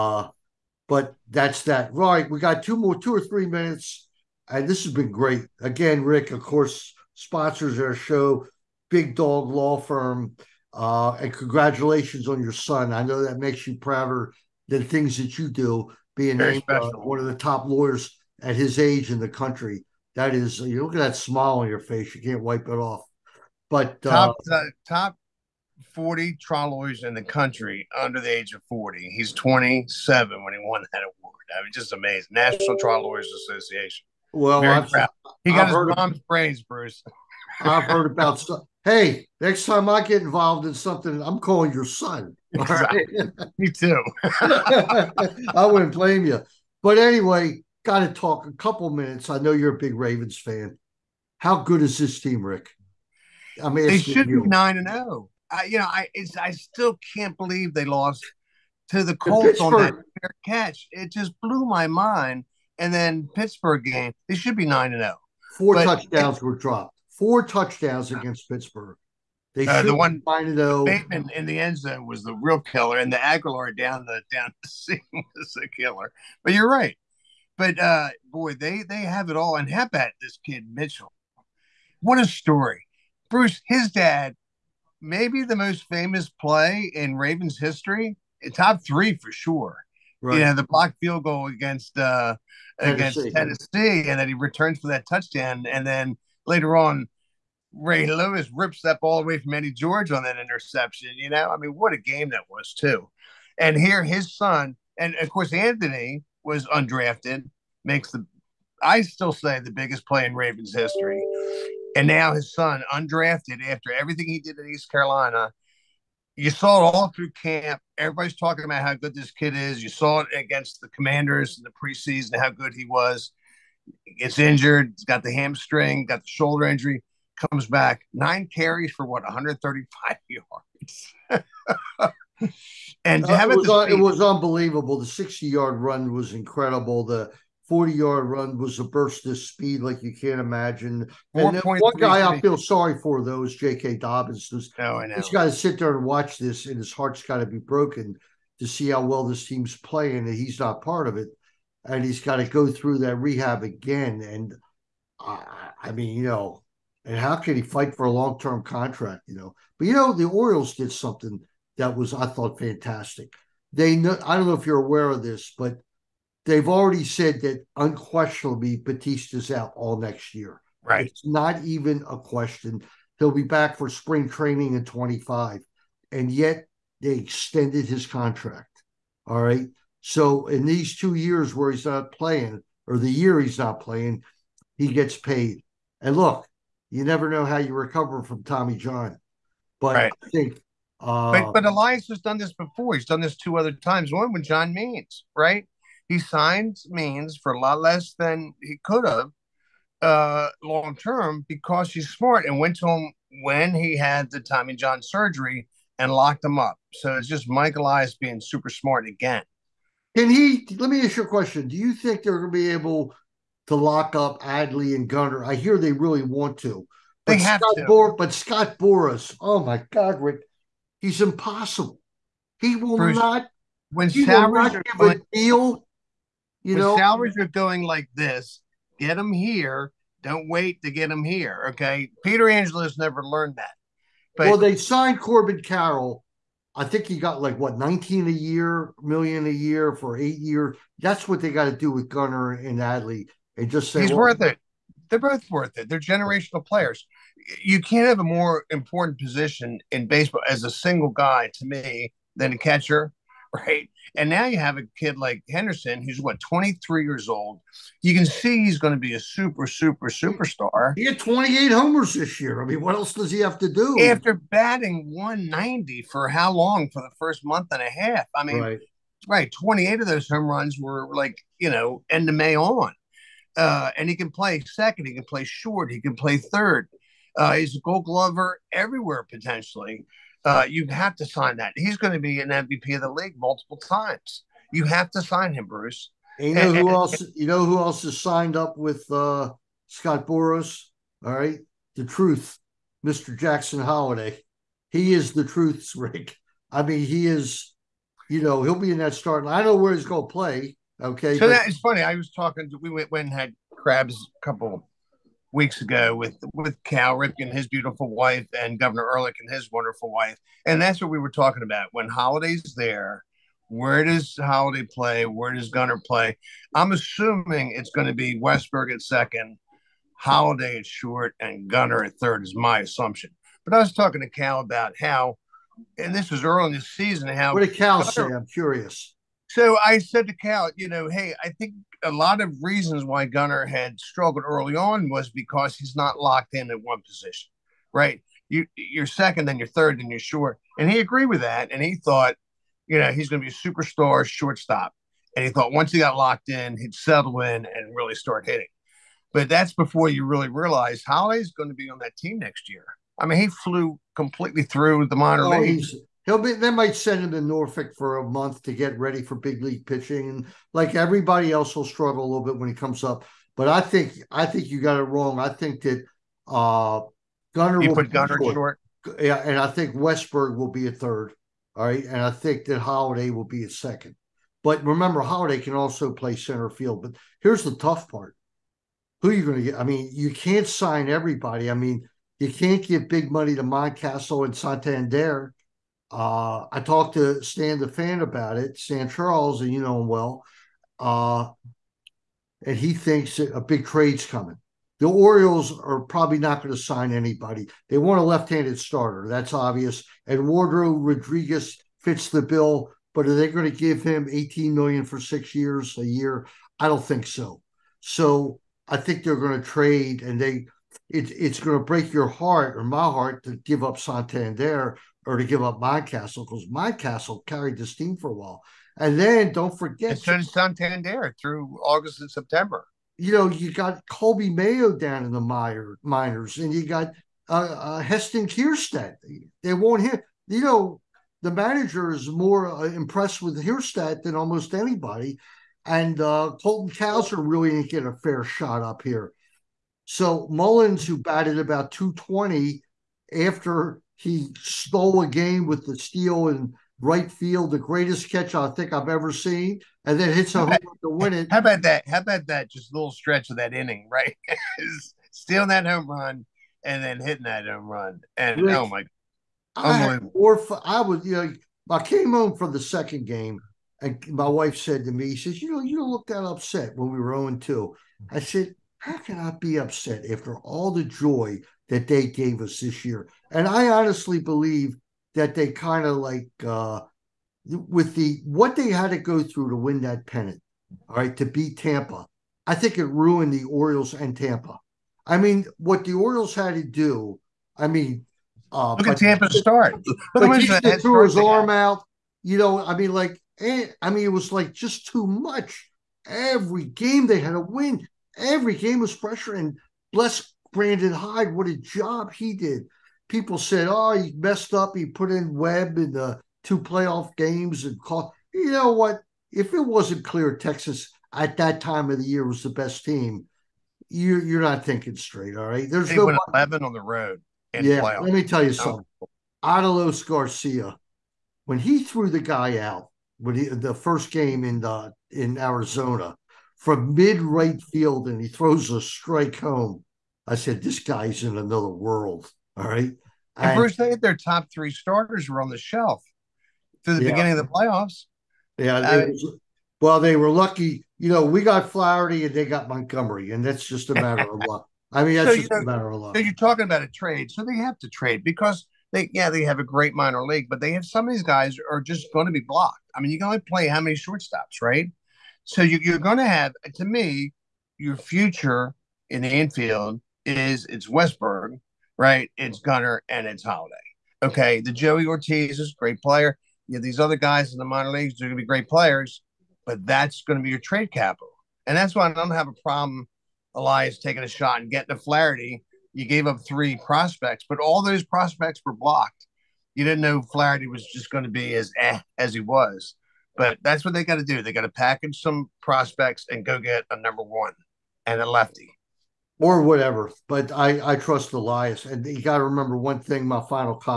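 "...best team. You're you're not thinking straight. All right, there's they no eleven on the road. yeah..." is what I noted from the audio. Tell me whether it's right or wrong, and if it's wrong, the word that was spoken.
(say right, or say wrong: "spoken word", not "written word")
right.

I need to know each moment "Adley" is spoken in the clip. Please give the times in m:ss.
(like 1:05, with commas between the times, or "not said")
3:34, 4:02.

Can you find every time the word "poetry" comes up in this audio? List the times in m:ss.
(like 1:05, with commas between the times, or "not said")
not said.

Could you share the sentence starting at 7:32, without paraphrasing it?
Just a little stretch of that inning, right?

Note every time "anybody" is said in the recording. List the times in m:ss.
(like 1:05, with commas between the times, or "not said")
6:37, 7:14.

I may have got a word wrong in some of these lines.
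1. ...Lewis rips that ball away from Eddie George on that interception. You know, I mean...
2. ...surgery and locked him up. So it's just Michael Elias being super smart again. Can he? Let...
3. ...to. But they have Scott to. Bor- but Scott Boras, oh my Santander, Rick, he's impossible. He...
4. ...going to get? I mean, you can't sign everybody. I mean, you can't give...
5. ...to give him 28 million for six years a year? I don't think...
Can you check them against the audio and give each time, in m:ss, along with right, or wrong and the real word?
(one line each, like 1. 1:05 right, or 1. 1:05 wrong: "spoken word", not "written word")
1. 1:38 right
2. 3:25 right
3. 3:36 wrong: "God", not "Santander"
4. 6:19 right
5. 6:43 wrong: "18", not "28".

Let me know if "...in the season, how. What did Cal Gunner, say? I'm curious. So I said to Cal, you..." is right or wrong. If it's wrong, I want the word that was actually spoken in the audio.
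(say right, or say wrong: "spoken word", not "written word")
right.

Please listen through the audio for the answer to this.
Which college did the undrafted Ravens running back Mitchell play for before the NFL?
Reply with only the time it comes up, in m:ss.
1:54.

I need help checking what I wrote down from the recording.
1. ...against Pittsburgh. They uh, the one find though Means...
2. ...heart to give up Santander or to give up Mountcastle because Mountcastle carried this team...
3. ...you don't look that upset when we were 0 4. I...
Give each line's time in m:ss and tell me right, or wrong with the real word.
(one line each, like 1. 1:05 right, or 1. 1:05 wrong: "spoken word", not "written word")
1. 1:08 wrong: "Bateman", not "Means"
2. 6:53 right
3. 7:45 wrong: "2", not "4".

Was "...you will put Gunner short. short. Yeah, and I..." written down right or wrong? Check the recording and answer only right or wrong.
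right.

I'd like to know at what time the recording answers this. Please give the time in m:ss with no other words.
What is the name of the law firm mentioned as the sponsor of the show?
0:08.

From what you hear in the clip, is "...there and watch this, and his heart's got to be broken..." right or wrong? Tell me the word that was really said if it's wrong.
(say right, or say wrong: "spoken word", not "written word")
right.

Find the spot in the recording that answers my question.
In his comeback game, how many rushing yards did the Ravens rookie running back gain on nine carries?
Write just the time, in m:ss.
2:09.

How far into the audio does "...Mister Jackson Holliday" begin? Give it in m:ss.
4:53.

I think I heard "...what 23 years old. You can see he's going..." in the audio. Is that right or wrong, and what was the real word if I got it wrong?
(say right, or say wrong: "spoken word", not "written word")
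right.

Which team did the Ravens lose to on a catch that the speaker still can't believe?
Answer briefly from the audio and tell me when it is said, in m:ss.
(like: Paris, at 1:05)
The Colts, at 0:59.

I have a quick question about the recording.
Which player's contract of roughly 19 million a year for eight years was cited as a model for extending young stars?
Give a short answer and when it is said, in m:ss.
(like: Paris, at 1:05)
Corbin Carroll, at 3:55.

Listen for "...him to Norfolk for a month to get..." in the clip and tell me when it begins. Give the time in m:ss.
5:57.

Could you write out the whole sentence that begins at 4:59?
I know where he's going to play.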